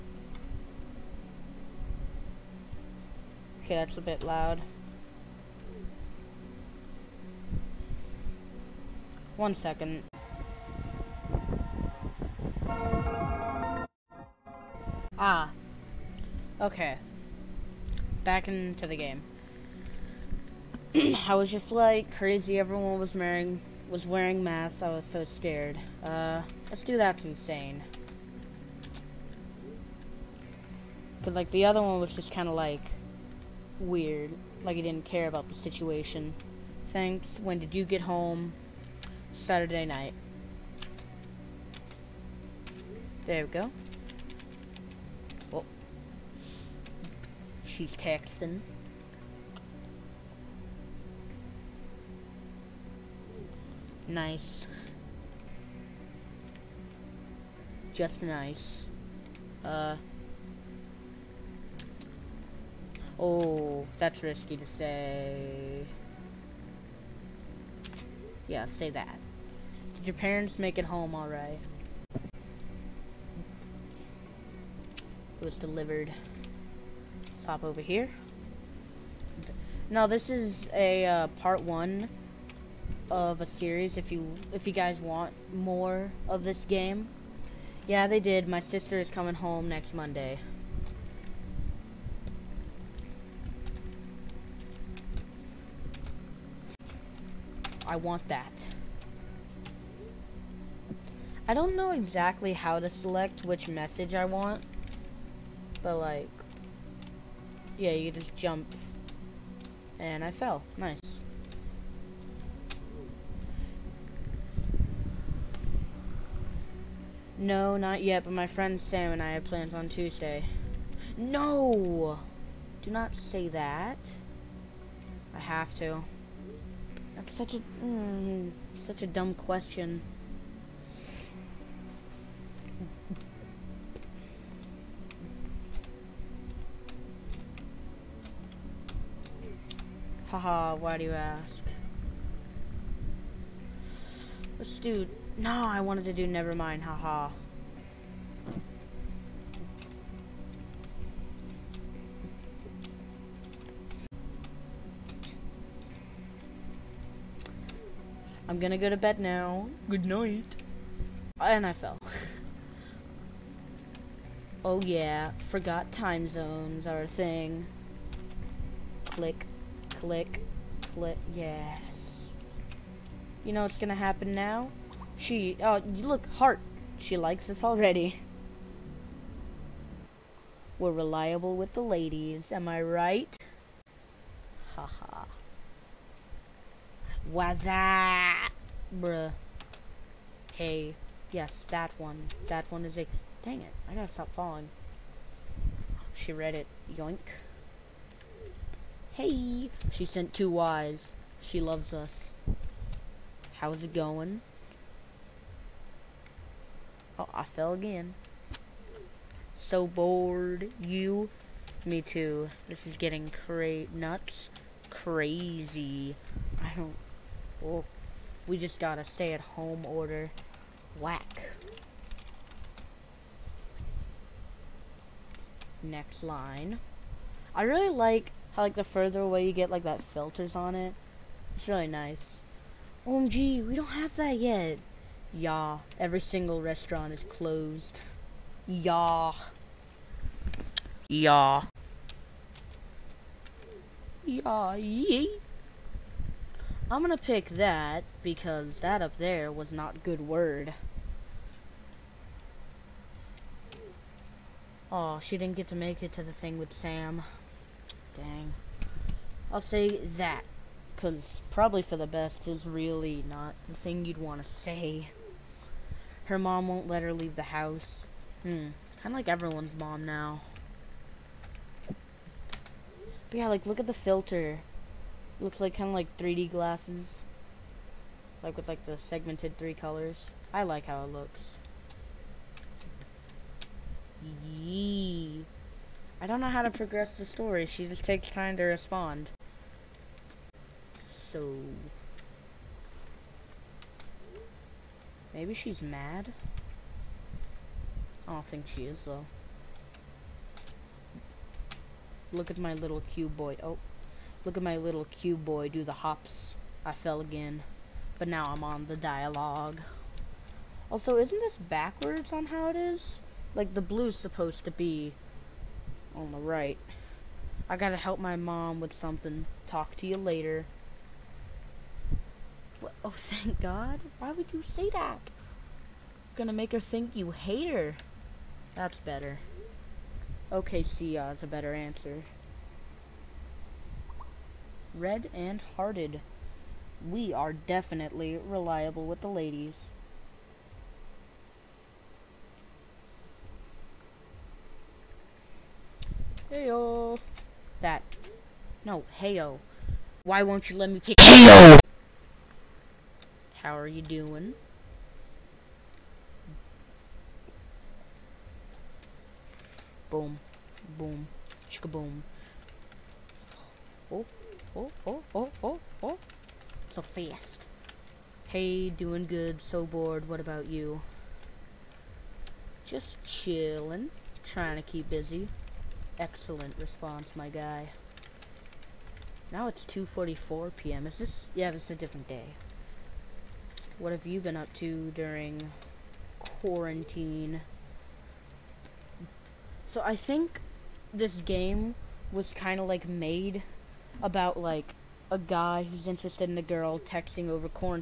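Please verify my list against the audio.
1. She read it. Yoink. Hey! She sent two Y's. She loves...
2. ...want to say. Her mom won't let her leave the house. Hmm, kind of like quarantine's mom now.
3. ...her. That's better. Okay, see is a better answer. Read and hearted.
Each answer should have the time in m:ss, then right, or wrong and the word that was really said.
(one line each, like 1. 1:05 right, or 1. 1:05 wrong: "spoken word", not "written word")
1. 3:16 right
2. 4:24 wrong: "everyone", not "quarantine"
3. 5:27 right.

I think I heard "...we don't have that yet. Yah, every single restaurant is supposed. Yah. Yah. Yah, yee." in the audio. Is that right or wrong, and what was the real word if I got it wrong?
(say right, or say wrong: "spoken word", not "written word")
wrong: "closed", not "supposed".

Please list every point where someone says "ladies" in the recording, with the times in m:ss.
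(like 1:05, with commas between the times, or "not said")
3:01, 5:39.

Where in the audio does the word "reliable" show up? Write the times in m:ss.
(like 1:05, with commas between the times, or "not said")
3:00, 5:38.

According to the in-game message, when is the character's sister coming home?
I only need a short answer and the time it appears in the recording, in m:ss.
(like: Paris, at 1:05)
Next Monday, at 1:29.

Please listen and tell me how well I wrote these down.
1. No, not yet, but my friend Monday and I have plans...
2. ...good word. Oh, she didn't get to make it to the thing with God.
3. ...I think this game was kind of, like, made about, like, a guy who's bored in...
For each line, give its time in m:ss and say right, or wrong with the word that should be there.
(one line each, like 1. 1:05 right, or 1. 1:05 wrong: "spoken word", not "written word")
1. 1:57 wrong: "Sam", not "Monday"
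2. 4:10 wrong: "Sam", not "God"
3. 6:30 wrong: "interested", not "bored".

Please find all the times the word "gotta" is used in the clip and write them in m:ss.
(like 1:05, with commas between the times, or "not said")
3:13, 5:17.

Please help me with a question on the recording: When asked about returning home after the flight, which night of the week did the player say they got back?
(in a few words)
Saturday night.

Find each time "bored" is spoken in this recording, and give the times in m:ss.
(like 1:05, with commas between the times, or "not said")
3:29, 6:09.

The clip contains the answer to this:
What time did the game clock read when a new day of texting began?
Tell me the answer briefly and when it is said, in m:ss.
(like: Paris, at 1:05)
2:44 p.m., at 6:19.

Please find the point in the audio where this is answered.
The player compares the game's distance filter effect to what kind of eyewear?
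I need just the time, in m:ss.
4:36.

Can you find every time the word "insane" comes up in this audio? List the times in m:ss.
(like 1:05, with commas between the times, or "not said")
0:27.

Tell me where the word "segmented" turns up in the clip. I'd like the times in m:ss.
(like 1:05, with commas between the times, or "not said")
4:38.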